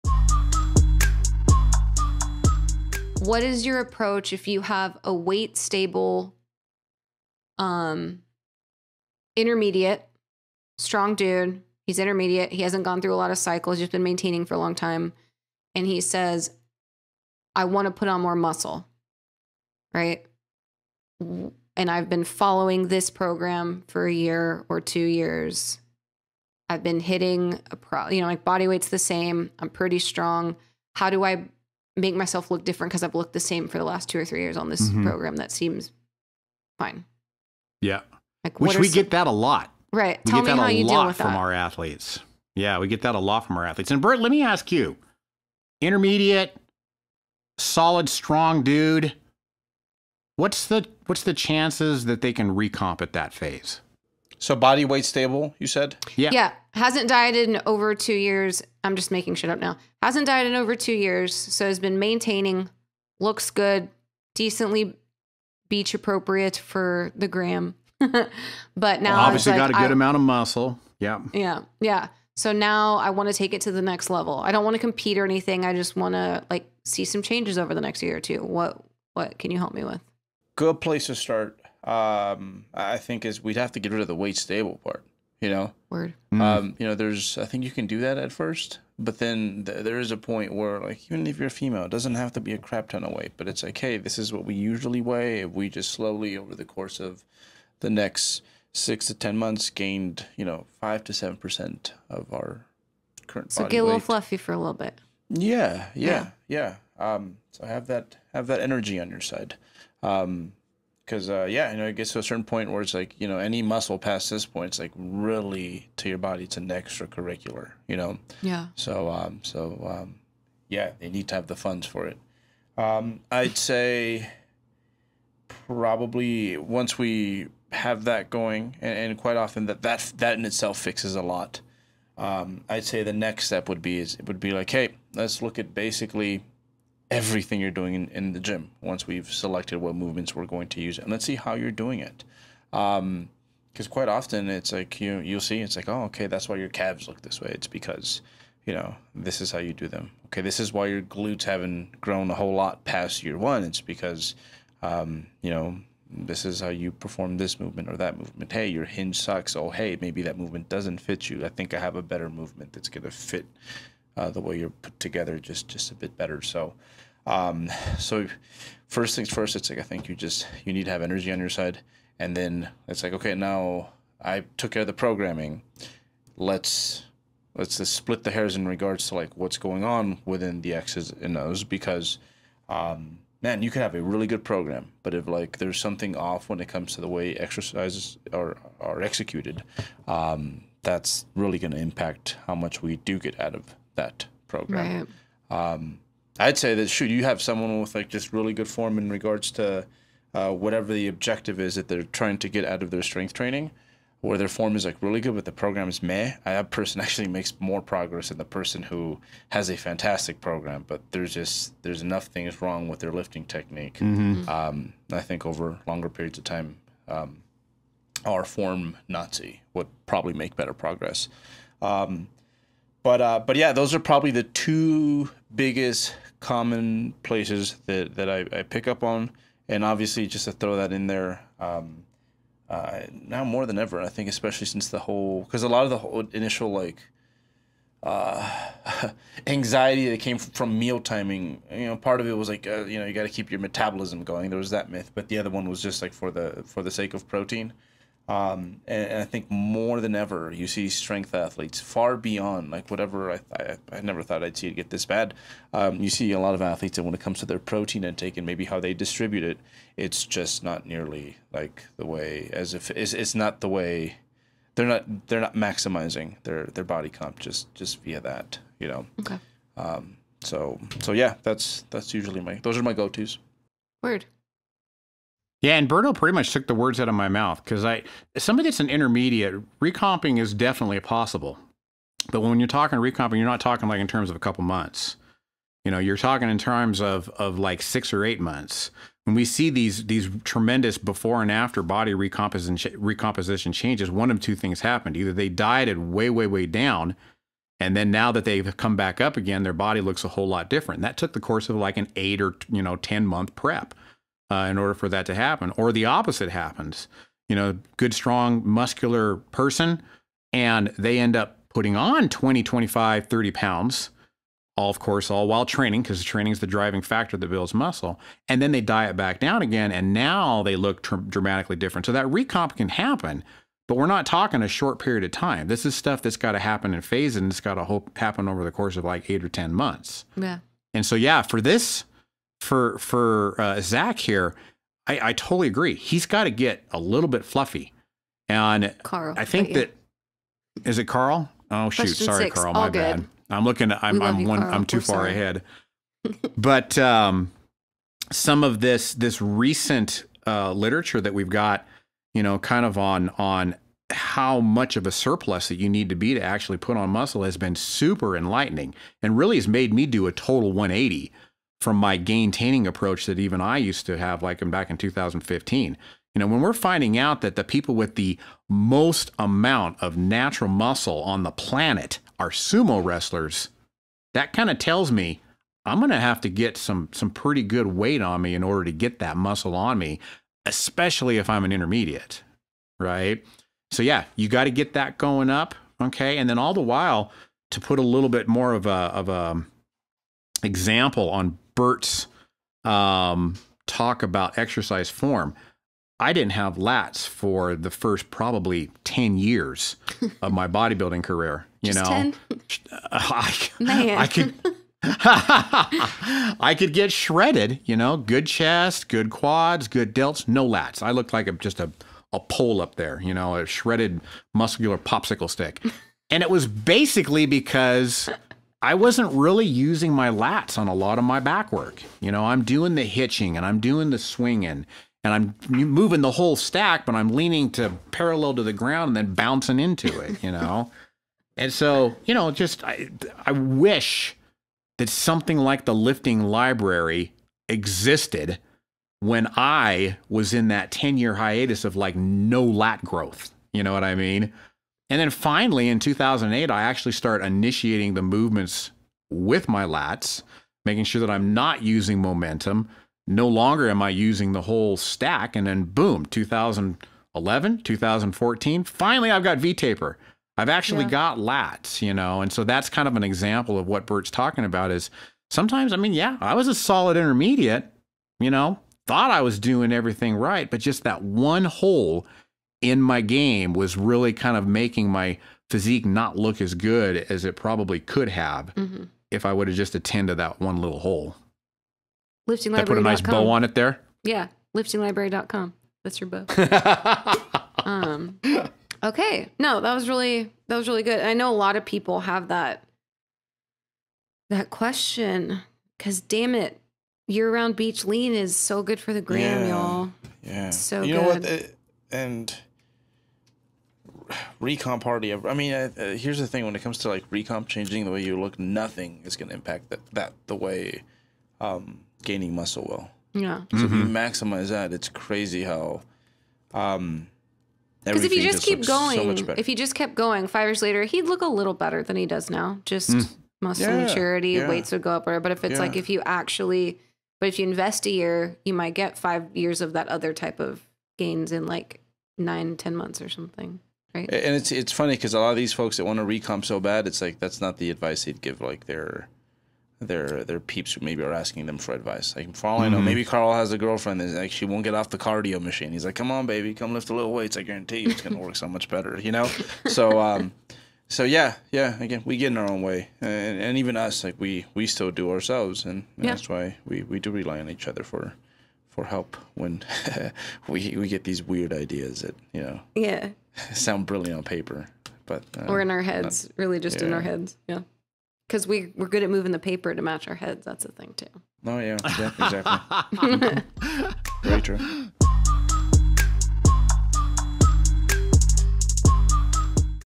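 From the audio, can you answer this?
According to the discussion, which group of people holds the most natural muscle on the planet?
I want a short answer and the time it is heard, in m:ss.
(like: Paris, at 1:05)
Sumo wrestlers, at 6:12.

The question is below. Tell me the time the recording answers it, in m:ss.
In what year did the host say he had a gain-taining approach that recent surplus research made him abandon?
6:04.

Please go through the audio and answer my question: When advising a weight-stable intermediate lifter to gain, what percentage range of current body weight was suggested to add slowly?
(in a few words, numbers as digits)
5 to 7 percent.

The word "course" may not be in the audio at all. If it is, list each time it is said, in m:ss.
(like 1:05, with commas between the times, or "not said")
1:36, 5:01, 5:14, 5:28.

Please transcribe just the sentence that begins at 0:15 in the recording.
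And he says, I want to put on more muscle, right?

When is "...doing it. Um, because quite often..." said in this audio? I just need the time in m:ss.
2:21.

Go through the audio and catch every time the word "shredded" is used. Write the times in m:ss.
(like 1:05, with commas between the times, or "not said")
6:47, 6:53.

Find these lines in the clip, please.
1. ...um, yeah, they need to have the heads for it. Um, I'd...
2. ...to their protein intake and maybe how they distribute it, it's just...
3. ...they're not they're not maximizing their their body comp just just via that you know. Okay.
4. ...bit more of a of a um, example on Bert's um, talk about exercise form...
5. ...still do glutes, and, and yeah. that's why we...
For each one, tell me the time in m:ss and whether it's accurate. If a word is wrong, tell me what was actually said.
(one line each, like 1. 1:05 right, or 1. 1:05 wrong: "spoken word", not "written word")
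1. 1:59 wrong: "funds", not "heads"
2. 4:17 right
3. 4:24 right
4. 6:28 right
5. 9:14 wrong: "ourselves", not "glutes".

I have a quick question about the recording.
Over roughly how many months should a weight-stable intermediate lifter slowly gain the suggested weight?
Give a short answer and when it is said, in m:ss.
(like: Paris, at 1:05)
6 to 10 months, at 1:38.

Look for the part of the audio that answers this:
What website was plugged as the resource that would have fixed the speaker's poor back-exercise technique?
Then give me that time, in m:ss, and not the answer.
8:04.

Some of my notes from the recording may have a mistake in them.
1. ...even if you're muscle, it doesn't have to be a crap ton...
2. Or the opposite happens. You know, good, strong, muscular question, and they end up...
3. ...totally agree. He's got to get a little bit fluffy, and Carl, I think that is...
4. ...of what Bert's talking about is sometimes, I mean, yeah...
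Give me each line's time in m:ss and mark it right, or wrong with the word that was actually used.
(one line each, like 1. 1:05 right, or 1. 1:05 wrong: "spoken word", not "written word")
1. 1:31 wrong: "female", not "muscle"
2. 5:05 wrong: "person", not "question"
3. 5:35 right
4. 7:43 right.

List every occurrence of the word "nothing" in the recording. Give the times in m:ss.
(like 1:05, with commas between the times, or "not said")
8:28.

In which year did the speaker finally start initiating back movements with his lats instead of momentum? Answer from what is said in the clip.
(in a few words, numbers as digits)
2008.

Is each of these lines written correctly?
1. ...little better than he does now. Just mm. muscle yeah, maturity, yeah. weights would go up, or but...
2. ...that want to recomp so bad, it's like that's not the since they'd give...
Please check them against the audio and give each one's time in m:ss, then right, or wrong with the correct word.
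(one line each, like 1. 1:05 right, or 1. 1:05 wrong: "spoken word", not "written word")
1. 8:41 right
2. 8:55 wrong: "advice", not "since".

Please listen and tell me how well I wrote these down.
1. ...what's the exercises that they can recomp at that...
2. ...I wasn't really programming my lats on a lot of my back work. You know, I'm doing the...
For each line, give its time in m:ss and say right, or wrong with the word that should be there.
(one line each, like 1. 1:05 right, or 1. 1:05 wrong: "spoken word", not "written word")
1. 0:51 wrong: "chances", not "exercises"
2. 6:58 wrong: "using", not "programming".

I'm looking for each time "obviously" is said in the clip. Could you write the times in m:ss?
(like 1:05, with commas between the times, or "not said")
1:09, 3:49.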